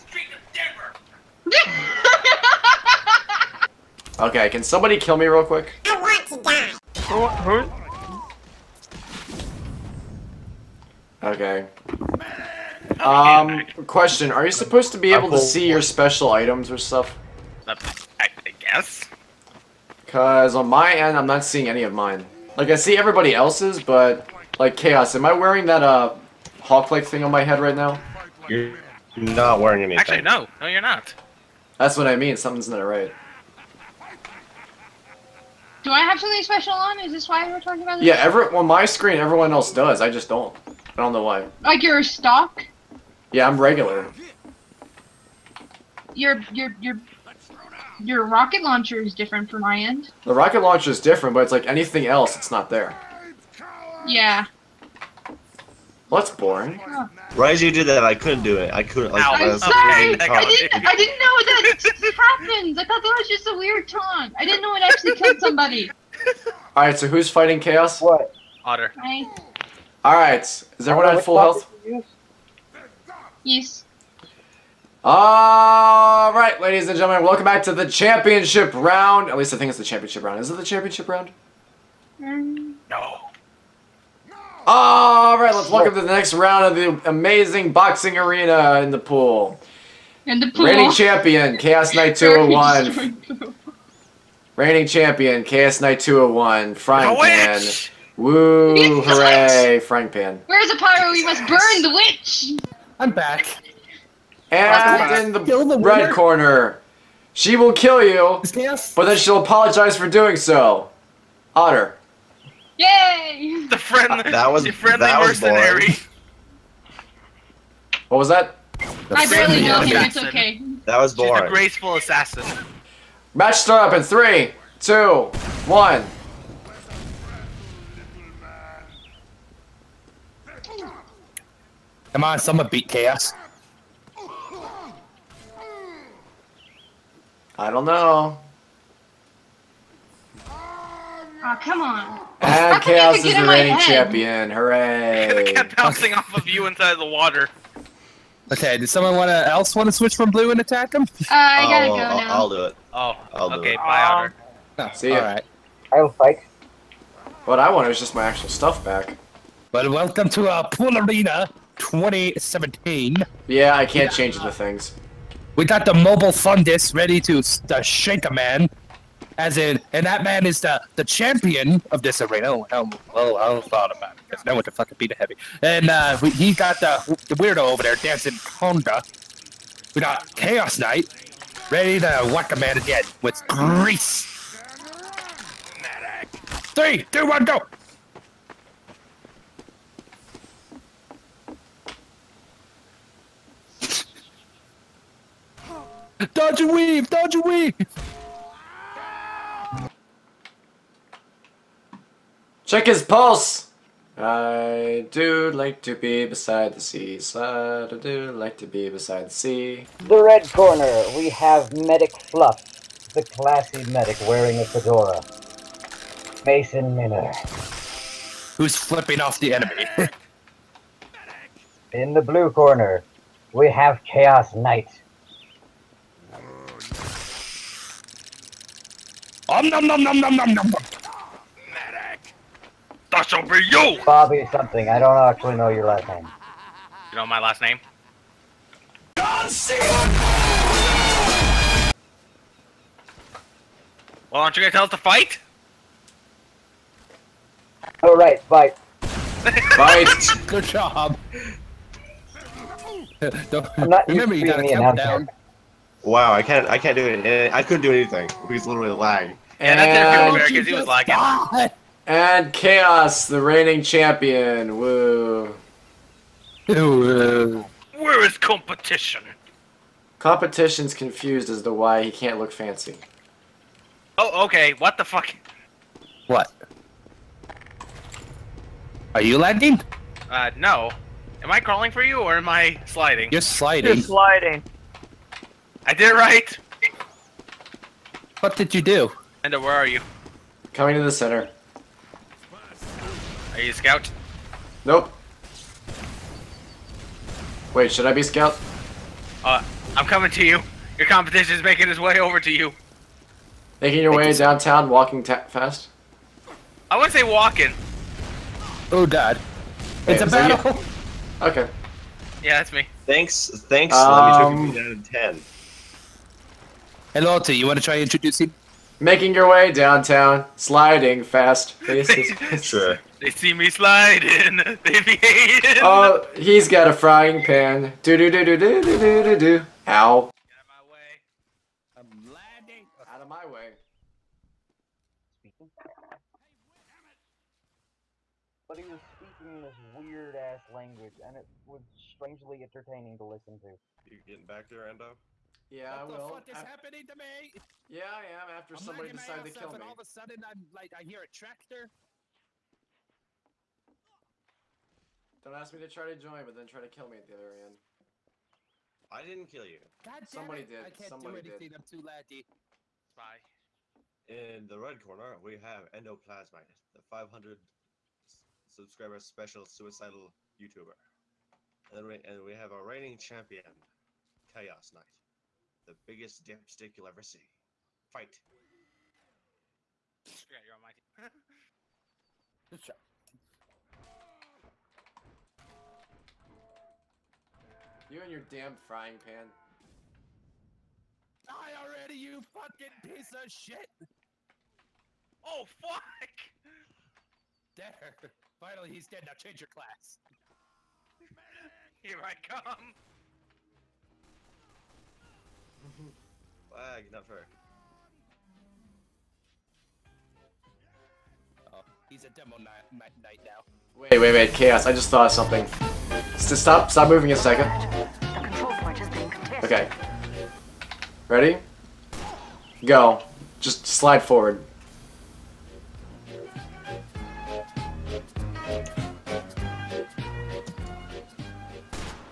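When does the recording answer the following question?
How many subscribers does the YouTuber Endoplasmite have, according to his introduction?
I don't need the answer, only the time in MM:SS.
06:07.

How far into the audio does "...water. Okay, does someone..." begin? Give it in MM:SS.
02:27.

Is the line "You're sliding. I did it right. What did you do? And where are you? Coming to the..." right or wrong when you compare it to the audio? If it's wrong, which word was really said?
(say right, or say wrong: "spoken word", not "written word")
right.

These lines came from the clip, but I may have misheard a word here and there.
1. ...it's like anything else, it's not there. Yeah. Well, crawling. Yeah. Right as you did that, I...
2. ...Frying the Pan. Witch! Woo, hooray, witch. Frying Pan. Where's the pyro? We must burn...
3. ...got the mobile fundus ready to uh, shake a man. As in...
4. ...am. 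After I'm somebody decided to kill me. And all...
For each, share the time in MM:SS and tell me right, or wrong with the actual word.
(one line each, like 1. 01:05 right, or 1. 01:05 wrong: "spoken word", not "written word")
1. 00:51 wrong: "boring", not "crawling"
2. 01:36 right
3. 02:45 right
4. 05:48 right.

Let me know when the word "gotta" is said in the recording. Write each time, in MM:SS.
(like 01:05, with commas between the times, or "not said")
02:31, 04:14.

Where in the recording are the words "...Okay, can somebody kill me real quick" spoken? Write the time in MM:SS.
00:04.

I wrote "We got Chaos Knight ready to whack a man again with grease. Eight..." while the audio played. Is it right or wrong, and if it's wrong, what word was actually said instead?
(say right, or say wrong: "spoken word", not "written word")
wrong: "Three", not "Eight".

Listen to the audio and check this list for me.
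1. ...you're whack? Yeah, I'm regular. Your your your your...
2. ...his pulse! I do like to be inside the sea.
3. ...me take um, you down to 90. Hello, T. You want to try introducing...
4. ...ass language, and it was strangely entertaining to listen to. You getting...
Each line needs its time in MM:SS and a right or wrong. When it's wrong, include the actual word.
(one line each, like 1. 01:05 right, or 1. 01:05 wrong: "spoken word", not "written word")
1. 00:41 wrong: "stock", not "whack"
2. 03:22 wrong: "beside", not "inside"
3. 05:14 wrong: "10", not "90"
4. 05:40 right.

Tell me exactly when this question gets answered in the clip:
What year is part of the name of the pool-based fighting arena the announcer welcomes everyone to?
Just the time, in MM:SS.
02:40.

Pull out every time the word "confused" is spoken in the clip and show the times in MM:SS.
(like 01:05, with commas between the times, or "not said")
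04:30.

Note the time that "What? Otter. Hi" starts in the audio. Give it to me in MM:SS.
01:08.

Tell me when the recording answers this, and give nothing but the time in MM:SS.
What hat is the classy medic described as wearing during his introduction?
03:34.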